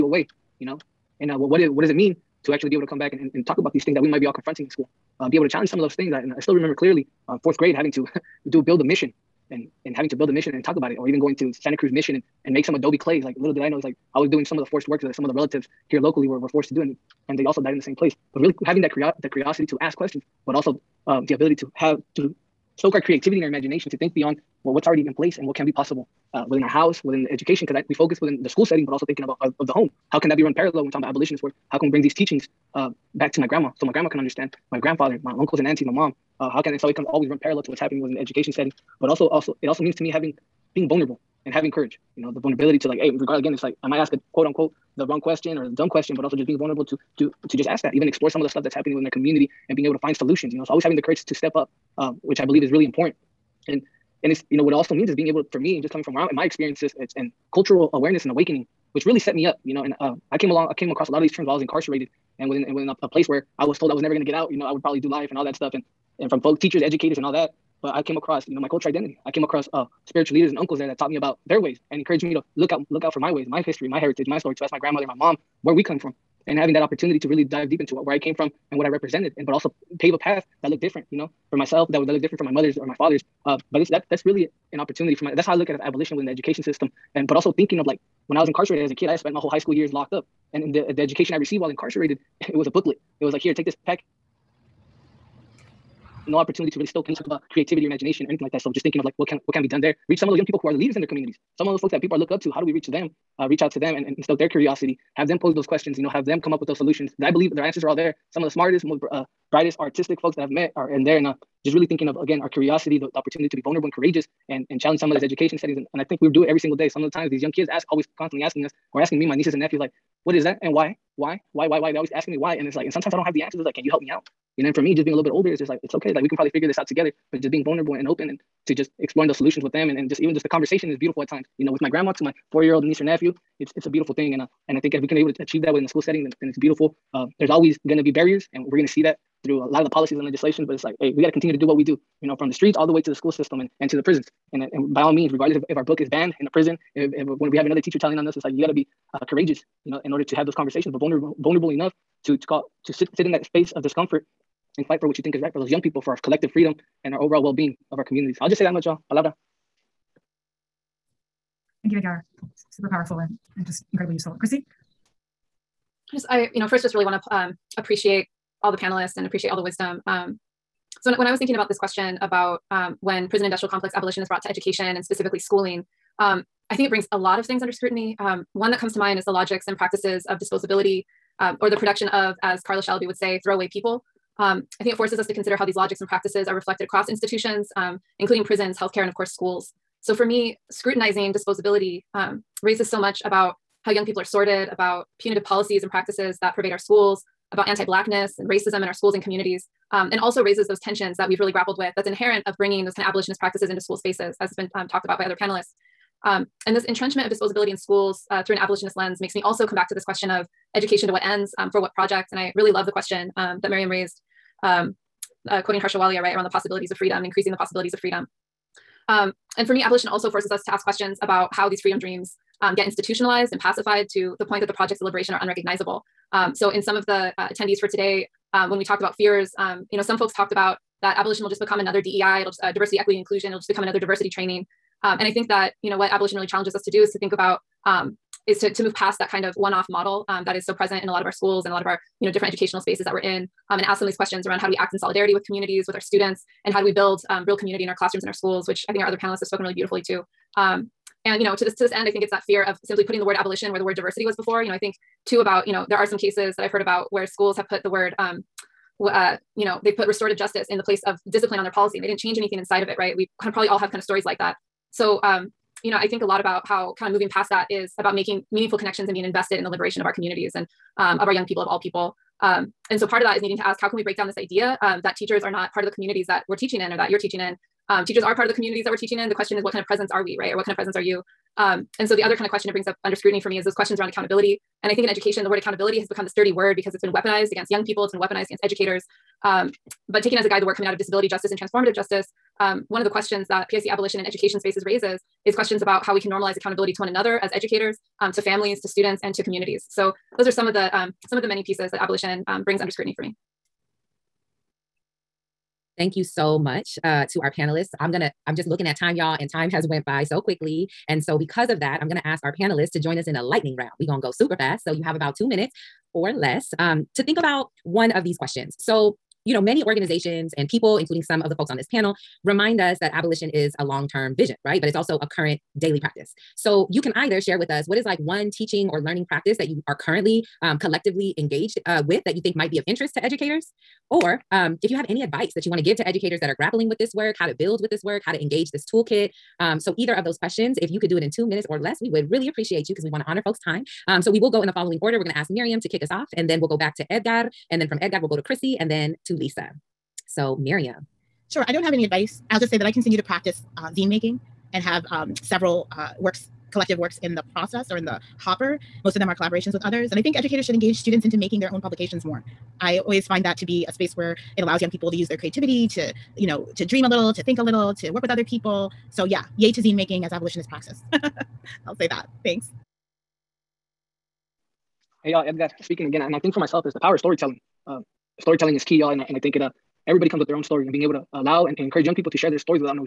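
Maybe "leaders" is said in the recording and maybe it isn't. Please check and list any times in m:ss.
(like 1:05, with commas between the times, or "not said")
1:10, 1:40.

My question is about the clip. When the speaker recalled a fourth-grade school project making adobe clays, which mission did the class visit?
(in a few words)
Santa Cruz Mission.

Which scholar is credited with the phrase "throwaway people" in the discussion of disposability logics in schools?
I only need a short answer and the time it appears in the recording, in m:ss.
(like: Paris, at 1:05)
Carla Shalaby, at 3:02.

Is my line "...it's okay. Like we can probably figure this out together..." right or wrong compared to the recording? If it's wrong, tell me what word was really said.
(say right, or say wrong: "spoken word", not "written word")
right.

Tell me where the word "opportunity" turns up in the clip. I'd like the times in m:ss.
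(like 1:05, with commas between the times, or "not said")
1:16, 1:24, 1:36, 1:53.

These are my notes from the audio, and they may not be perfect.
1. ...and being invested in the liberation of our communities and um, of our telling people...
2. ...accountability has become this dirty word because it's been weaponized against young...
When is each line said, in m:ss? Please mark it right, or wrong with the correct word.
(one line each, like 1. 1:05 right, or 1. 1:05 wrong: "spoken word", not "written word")
1. 4:29 wrong: "young", not "telling"
2. 4:45 right.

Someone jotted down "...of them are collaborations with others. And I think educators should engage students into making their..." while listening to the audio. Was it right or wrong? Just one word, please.
right.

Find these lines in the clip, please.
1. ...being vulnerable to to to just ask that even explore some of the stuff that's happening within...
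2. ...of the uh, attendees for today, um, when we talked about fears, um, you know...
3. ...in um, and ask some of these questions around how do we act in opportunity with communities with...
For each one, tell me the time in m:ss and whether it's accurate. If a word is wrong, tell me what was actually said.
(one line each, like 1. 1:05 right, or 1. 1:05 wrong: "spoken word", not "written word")
1. 0:46 right
2. 3:46 right
3. 4:03 wrong: "solidarity", not "opportunity".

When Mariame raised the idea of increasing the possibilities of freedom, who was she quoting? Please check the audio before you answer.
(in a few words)
Harsha Walia.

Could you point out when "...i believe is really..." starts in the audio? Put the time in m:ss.
0:52.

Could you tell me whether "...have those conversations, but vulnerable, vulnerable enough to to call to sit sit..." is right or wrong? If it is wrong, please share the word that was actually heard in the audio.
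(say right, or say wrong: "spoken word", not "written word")
right.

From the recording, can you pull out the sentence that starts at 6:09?
So, yeah, yay to zine making as abolitionist praxis.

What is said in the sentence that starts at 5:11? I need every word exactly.
And so because of that, I'm going to ask our panelists to join us in a lightning round.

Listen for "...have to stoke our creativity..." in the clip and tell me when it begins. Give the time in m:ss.
0:21.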